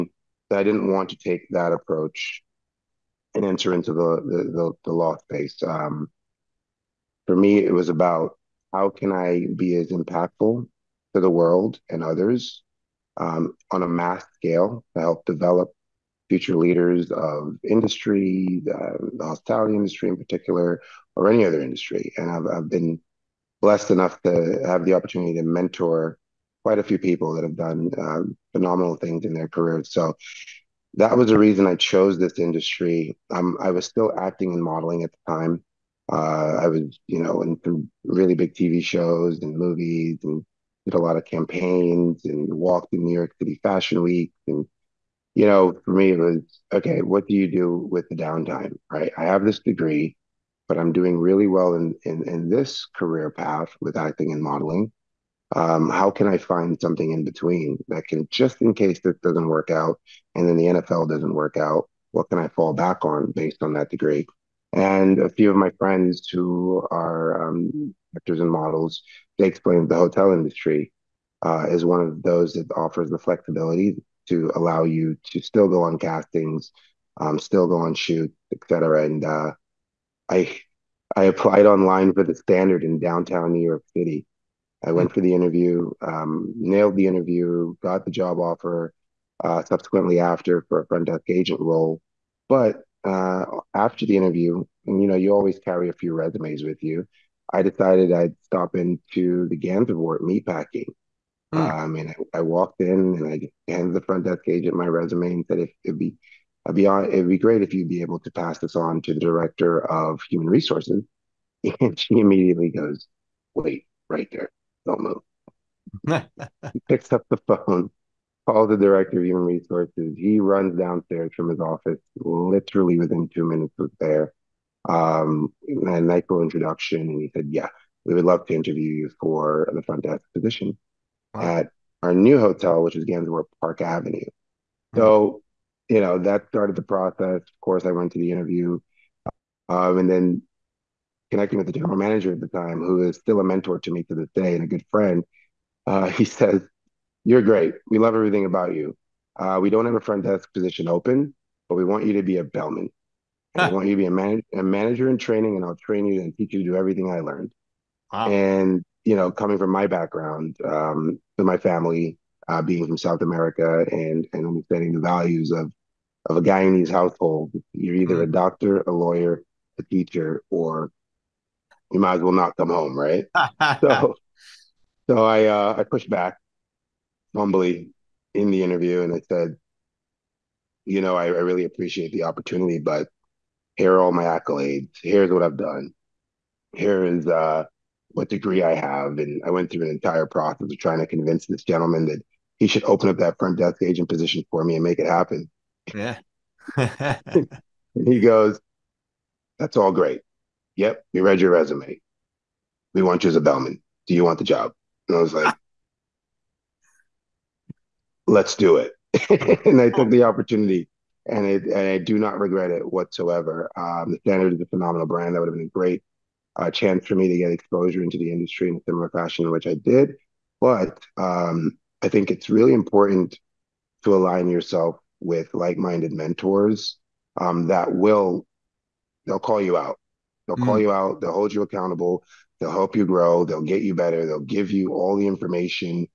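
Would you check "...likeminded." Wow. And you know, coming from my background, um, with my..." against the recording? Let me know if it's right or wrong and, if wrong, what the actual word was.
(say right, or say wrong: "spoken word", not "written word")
wrong: "learned", not "likeminded".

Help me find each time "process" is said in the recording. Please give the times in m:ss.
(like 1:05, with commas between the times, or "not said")
2:16, 3:10.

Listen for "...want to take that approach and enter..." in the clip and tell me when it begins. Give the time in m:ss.
0:00.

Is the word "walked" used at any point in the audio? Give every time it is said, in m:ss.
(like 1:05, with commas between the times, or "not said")
0:42, 1:42.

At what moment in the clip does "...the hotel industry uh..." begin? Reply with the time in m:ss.
1:09.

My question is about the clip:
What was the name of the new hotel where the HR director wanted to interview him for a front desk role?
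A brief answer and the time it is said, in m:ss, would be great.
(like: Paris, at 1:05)
Gansevoort Park Avenue, at 2:13.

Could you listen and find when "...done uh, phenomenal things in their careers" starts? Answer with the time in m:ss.
0:27.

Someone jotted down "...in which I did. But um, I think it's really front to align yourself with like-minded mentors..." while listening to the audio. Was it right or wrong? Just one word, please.
wrong.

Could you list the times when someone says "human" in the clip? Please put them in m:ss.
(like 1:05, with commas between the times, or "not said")
1:50, 1:59.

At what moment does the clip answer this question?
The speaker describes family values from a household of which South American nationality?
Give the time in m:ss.
2:46.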